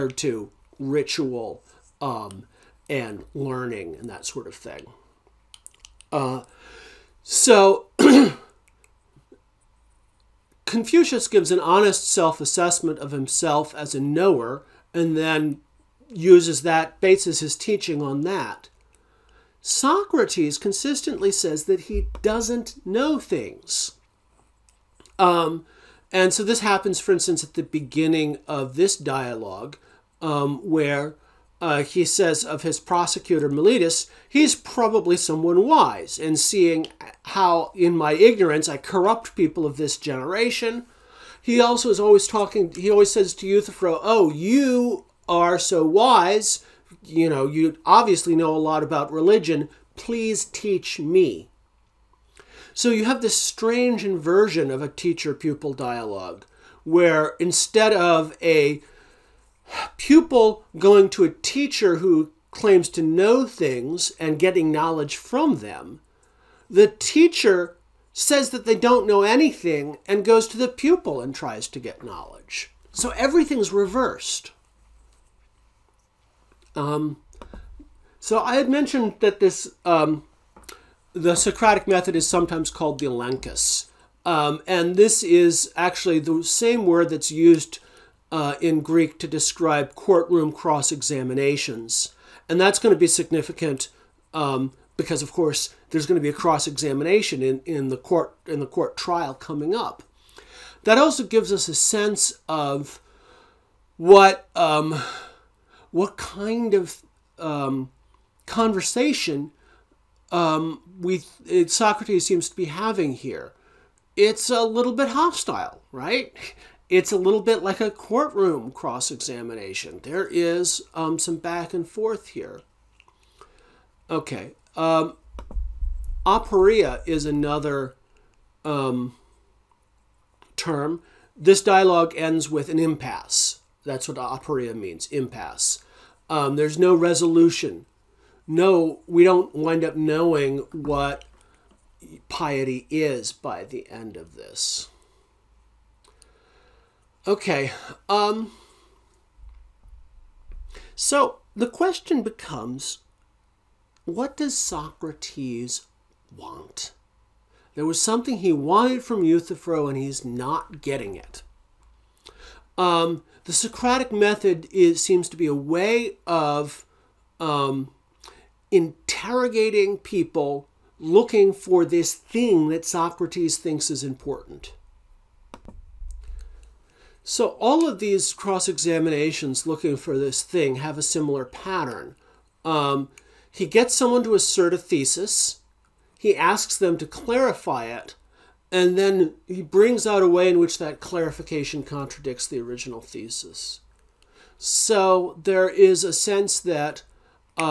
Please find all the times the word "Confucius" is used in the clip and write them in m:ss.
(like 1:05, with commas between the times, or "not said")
0:10.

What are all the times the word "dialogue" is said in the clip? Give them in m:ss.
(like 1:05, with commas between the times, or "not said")
0:28, 0:55, 2:11.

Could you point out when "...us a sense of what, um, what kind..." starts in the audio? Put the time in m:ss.
1:41.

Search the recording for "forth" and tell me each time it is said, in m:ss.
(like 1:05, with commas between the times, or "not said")
2:01.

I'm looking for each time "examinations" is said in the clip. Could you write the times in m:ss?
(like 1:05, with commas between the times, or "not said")
1:30, 1:36, 1:59, 2:58.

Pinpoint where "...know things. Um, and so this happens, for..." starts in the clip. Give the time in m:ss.
0:22.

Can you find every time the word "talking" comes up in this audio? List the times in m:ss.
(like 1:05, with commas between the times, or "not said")
0:42.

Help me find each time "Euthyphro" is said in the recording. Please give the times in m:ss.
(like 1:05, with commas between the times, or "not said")
0:43, 2:39.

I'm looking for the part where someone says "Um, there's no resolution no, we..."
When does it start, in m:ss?
2:16.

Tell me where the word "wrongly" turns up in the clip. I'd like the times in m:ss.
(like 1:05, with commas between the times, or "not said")
not said.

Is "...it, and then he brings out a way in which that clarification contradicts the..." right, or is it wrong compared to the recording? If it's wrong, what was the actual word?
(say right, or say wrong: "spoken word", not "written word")
right.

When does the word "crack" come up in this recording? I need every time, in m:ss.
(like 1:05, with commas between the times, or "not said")
not said.